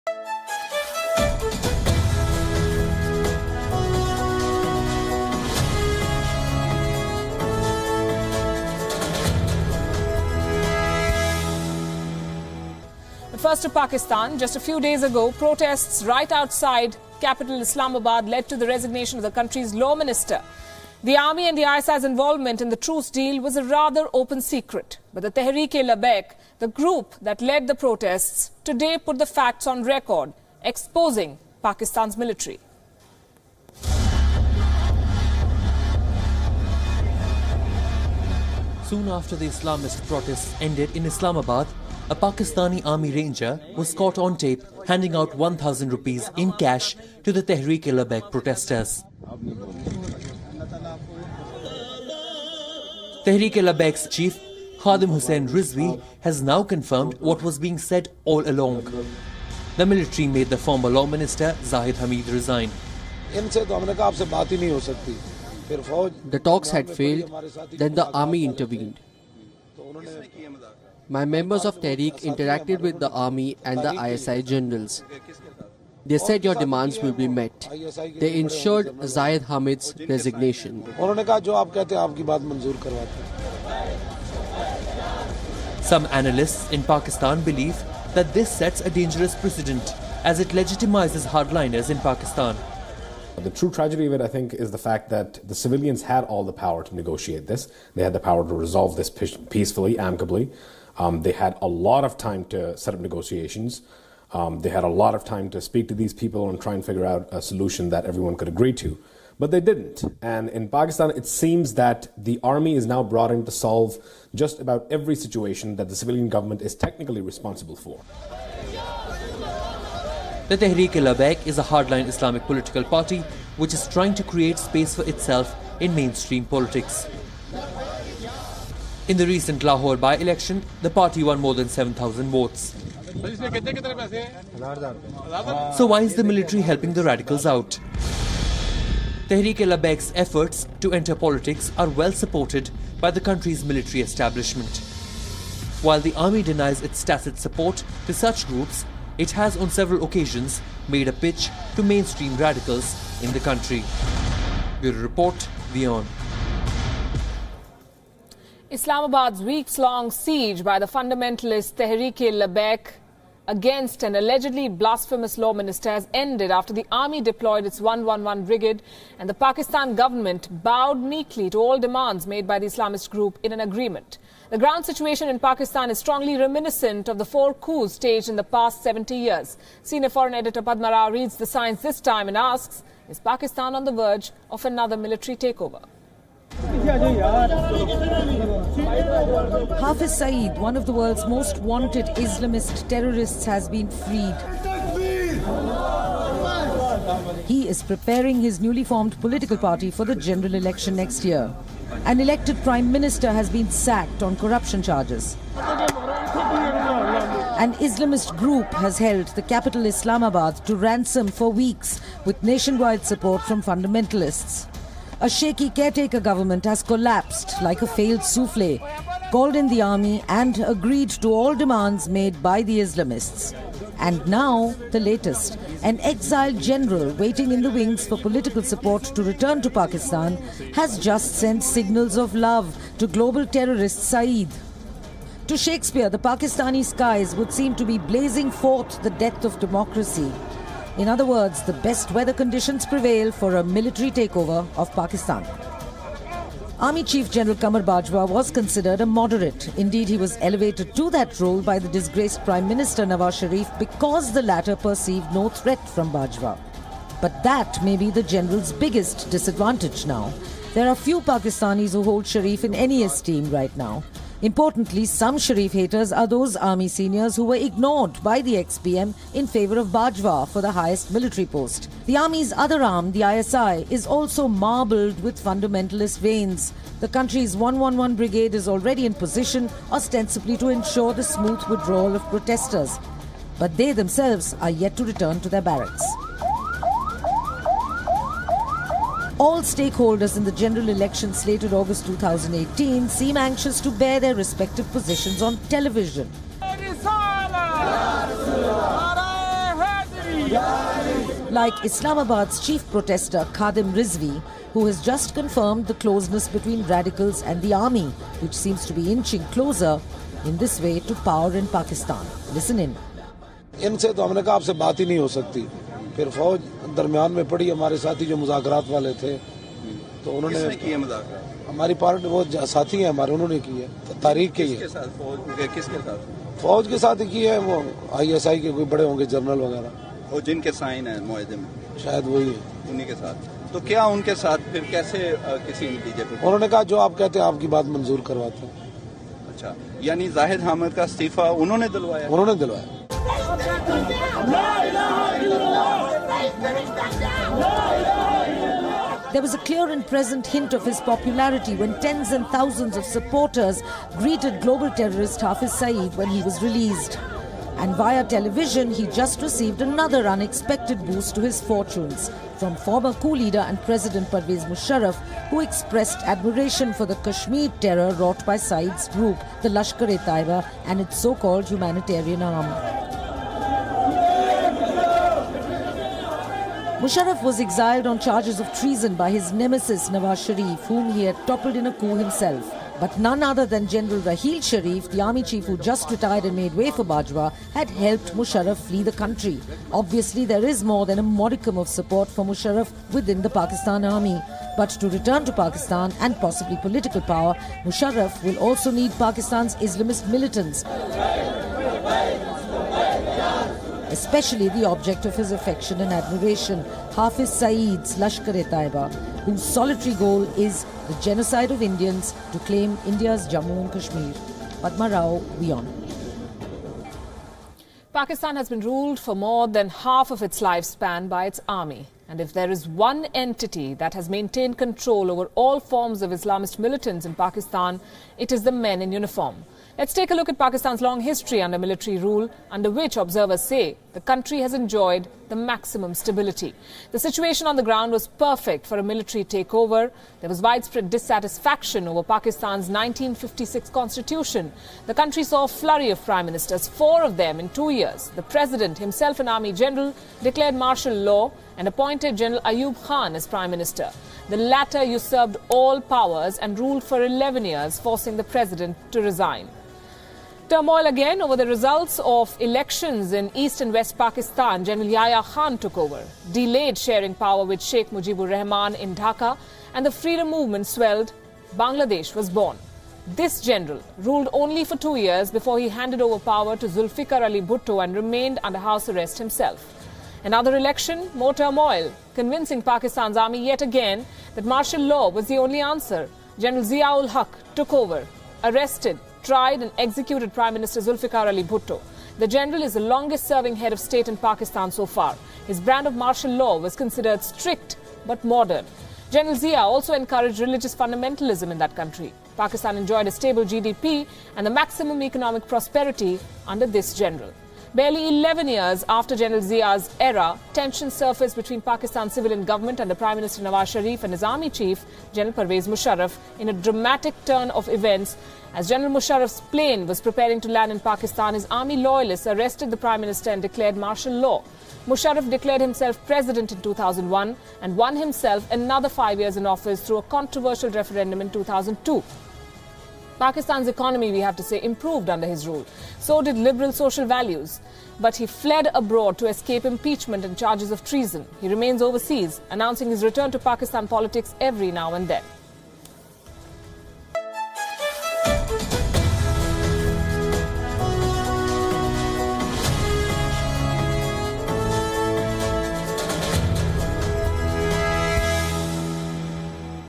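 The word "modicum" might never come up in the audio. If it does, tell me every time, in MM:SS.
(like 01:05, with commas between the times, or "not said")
06:31.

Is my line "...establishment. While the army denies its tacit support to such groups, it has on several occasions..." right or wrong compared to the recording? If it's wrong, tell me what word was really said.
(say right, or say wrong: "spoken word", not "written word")
right.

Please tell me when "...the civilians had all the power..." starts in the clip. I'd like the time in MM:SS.
01:35.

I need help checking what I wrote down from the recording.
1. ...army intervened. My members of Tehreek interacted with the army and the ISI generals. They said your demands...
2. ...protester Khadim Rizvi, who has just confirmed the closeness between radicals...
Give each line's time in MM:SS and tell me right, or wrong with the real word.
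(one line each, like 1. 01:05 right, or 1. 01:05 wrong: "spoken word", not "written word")
1. 01:08 right
2. 05:02 right.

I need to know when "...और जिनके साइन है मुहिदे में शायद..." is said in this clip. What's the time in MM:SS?
05:30.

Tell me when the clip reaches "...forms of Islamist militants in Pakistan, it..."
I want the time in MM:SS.
07:05.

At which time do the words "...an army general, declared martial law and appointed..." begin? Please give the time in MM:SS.
07:29.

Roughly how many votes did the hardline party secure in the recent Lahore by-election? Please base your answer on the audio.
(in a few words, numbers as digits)
more than 7,000.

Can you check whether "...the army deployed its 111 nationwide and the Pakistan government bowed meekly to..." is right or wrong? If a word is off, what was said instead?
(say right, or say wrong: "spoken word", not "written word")
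wrong: "brigade", not "nationwide".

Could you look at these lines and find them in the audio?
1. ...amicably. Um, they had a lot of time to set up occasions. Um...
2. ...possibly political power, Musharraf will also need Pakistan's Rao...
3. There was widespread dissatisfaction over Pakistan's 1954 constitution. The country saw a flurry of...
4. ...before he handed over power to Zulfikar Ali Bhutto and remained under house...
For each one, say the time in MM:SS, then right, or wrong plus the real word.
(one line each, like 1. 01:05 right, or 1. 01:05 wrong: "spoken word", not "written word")
1. 01:39 wrong: "negotiations", not "occasions"
2. 06:36 wrong: "Islamist", not "Rao"
3. 07:20 wrong: "1956", not "1954"
4. 07:55 right.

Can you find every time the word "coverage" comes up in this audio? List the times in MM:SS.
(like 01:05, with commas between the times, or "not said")
not said.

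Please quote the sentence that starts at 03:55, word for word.
To Shakespeare, the Pakistani skies would seem to be blazing forth the death of democracy.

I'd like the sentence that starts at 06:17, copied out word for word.
Musharraf was exiled on charges of treason by his nemesis Nawaz Sharif, whom he had toppled in a coup himself.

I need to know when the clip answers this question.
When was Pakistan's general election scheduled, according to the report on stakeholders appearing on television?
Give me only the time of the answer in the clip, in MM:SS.
04:51.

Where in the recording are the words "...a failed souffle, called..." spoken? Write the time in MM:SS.
03:37.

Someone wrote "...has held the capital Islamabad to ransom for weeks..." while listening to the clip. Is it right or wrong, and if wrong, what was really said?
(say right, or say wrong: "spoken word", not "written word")
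right.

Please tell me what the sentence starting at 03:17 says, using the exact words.
He is preparing his newly formed political party for the general election next year.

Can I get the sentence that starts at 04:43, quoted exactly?
But they themselves are yet to return to their barracks.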